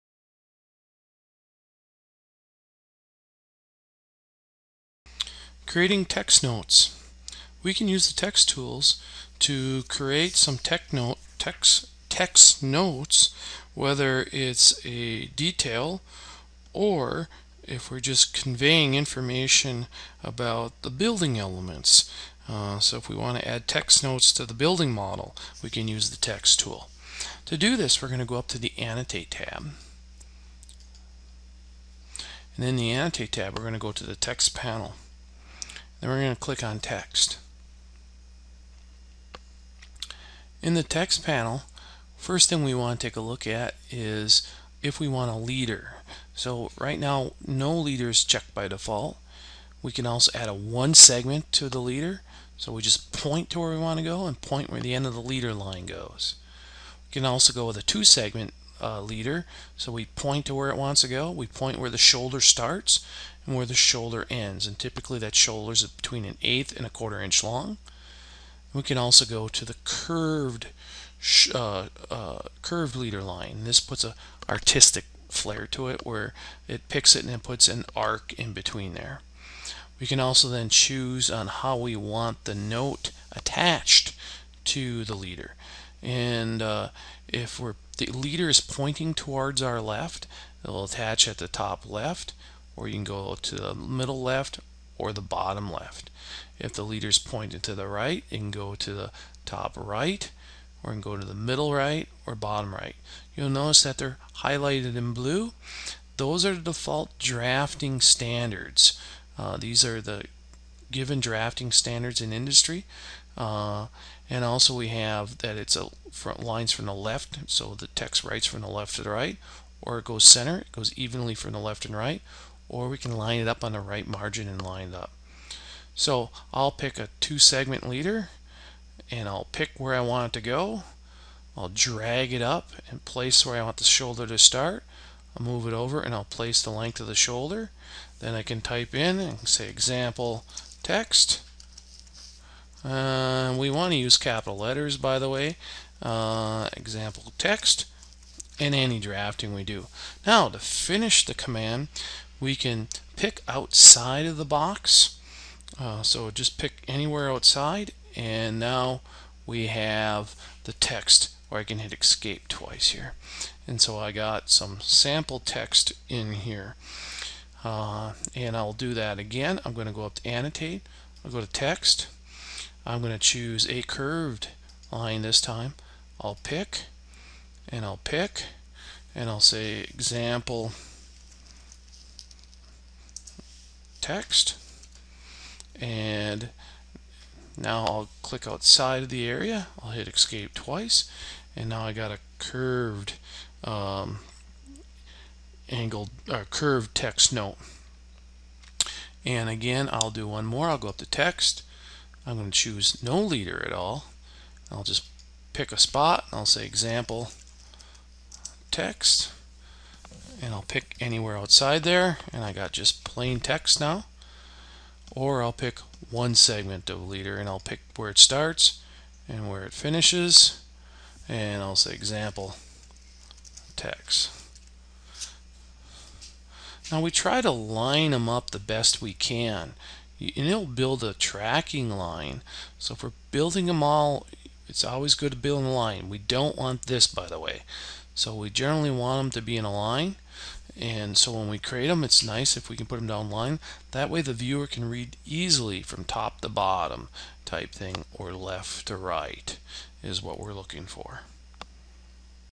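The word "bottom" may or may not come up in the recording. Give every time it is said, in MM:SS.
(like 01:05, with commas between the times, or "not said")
01:35, 01:42, 04:06.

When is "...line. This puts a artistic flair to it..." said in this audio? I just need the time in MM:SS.
01:13.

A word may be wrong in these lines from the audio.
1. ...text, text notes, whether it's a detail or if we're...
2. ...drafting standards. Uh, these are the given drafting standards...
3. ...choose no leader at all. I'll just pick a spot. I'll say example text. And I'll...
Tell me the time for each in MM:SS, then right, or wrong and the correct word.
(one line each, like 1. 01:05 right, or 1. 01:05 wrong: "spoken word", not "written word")
1. 00:11 right
2. 01:47 right
3. 03:22 right.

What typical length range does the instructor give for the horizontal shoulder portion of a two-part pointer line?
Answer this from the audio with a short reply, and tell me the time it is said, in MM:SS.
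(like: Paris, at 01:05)
an eighth and a quarter inch, at 01:06.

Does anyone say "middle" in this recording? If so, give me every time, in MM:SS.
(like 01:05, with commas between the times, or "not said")
01:33, 01:41.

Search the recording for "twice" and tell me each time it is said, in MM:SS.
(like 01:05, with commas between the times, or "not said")
02:42, 03:10.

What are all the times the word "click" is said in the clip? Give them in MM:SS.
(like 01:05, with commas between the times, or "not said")
00:36, 03:08.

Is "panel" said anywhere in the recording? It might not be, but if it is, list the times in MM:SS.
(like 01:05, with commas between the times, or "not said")
00:34, 00:41.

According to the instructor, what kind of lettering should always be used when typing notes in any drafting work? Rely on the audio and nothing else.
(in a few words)
Capital letters.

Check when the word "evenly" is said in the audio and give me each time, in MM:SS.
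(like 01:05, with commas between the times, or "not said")
02:00.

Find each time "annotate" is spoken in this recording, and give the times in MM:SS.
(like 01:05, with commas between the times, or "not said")
00:28, 00:32, 02:50.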